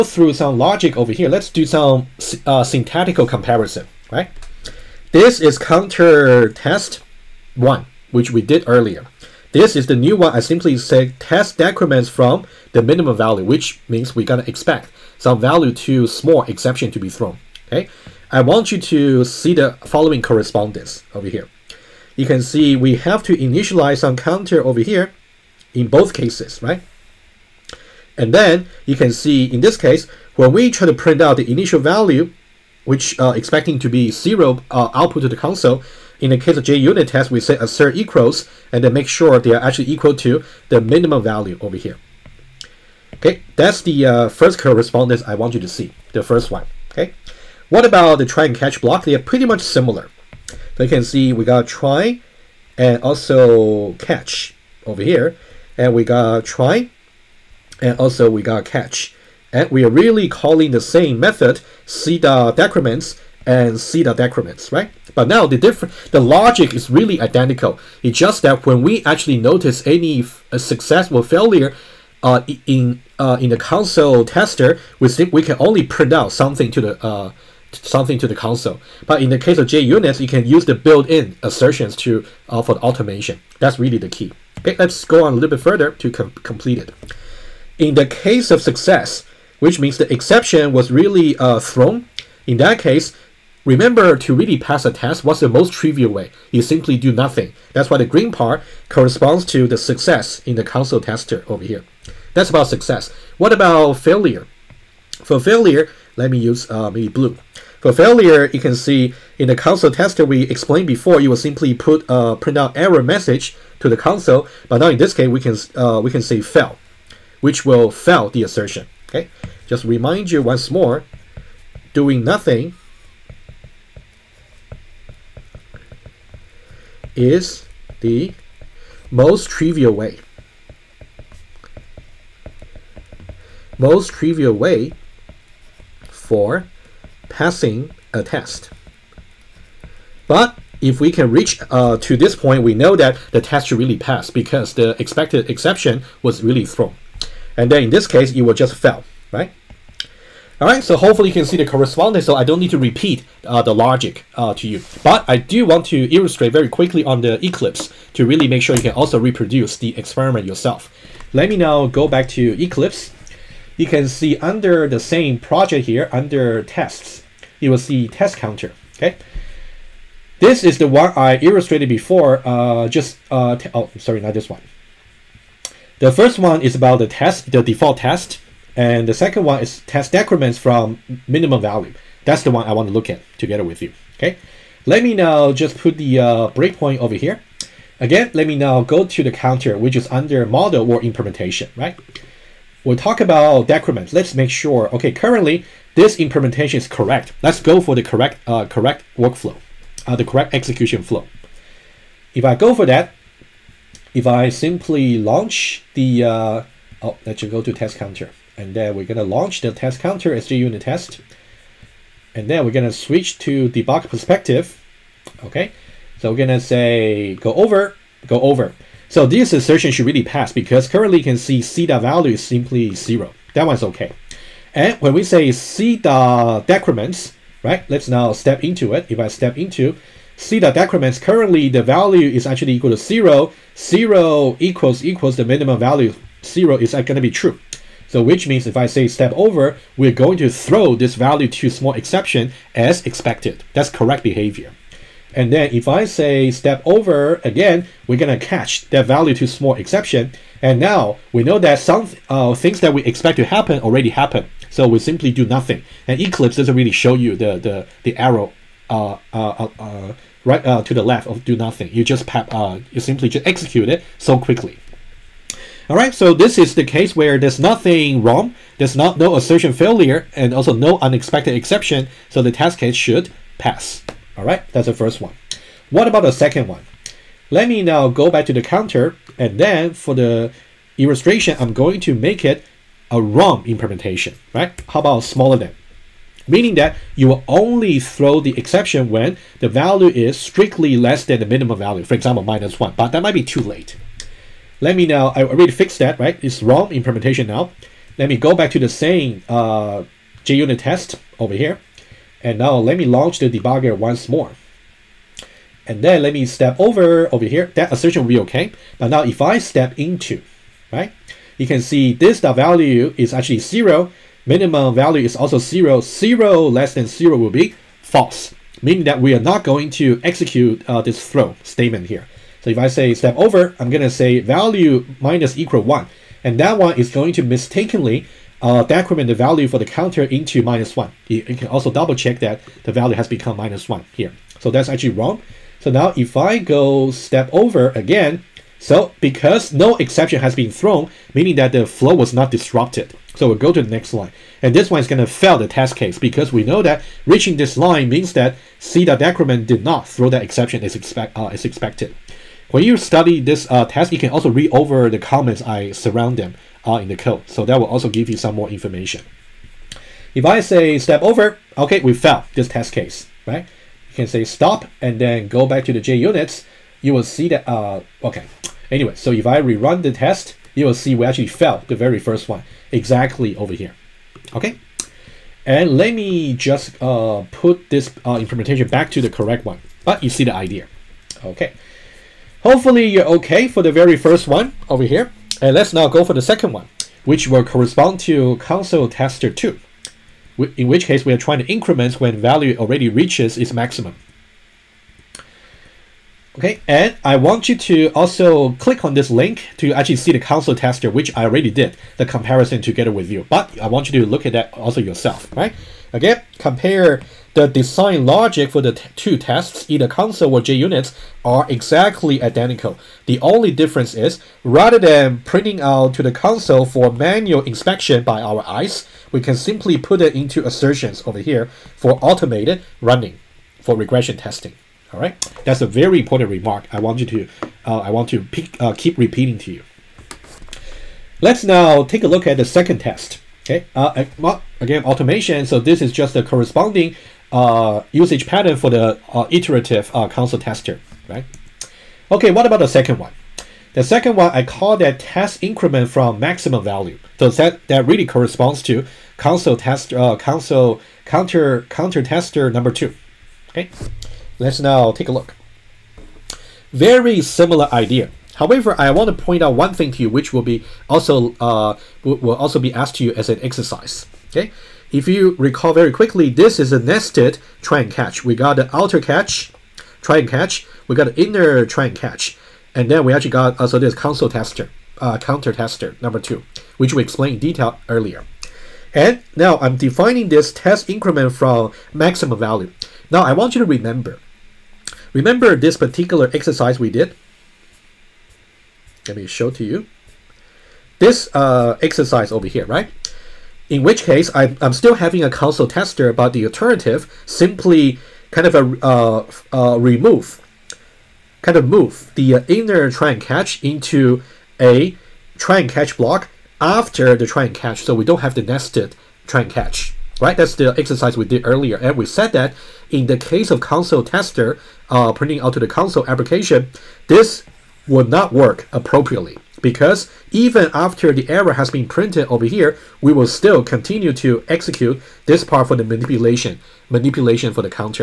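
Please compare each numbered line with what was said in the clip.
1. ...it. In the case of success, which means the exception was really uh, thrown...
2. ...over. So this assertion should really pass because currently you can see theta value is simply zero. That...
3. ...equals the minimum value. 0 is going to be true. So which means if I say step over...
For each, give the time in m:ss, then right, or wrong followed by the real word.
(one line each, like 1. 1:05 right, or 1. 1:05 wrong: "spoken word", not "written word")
1. 1:26 right
2. 3:38 right
3. 3:55 right.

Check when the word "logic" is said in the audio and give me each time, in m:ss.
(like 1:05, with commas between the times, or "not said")
0:00, 1:06, 2:33, 6:48.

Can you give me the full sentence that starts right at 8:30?
That's the exercise we did earlier.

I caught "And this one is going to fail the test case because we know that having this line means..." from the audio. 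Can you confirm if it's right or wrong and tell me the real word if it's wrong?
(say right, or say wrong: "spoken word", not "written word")
wrong: "reaching", not "having".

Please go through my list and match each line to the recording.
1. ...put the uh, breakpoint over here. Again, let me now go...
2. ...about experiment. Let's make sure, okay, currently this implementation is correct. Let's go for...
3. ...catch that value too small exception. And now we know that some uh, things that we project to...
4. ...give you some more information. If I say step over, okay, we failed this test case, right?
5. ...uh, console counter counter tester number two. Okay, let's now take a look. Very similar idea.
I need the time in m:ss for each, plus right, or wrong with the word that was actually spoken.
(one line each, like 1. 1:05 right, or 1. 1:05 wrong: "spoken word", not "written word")
1. 3:05 right
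2. 3:13 wrong: "decrement", not "experiment"
3. 4:08 wrong: "expect", not "project"
4. 5:58 right
5. 7:30 right.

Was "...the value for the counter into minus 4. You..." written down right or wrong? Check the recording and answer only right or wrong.
wrong.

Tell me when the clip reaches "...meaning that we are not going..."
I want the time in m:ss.
5:18.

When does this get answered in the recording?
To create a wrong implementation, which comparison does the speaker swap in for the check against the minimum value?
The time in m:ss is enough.
4:45.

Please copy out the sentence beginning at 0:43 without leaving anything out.
Okay, that's the uh, first correspondence I want you to see, the first one, okay?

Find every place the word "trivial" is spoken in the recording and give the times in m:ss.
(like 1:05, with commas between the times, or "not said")
1:35, 2:09, 2:14.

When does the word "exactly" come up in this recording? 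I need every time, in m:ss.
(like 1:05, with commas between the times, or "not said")
6:12, 6:51.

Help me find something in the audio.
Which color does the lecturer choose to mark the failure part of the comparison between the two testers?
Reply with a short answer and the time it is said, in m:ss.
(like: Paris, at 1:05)
blue, at 1:47.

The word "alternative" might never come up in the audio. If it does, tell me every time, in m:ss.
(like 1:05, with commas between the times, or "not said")
8:16.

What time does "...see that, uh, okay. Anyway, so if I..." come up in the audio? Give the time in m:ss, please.
6:07.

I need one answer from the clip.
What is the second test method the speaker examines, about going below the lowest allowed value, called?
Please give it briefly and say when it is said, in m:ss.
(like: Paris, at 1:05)
test decrements from minimum value, at 2:59.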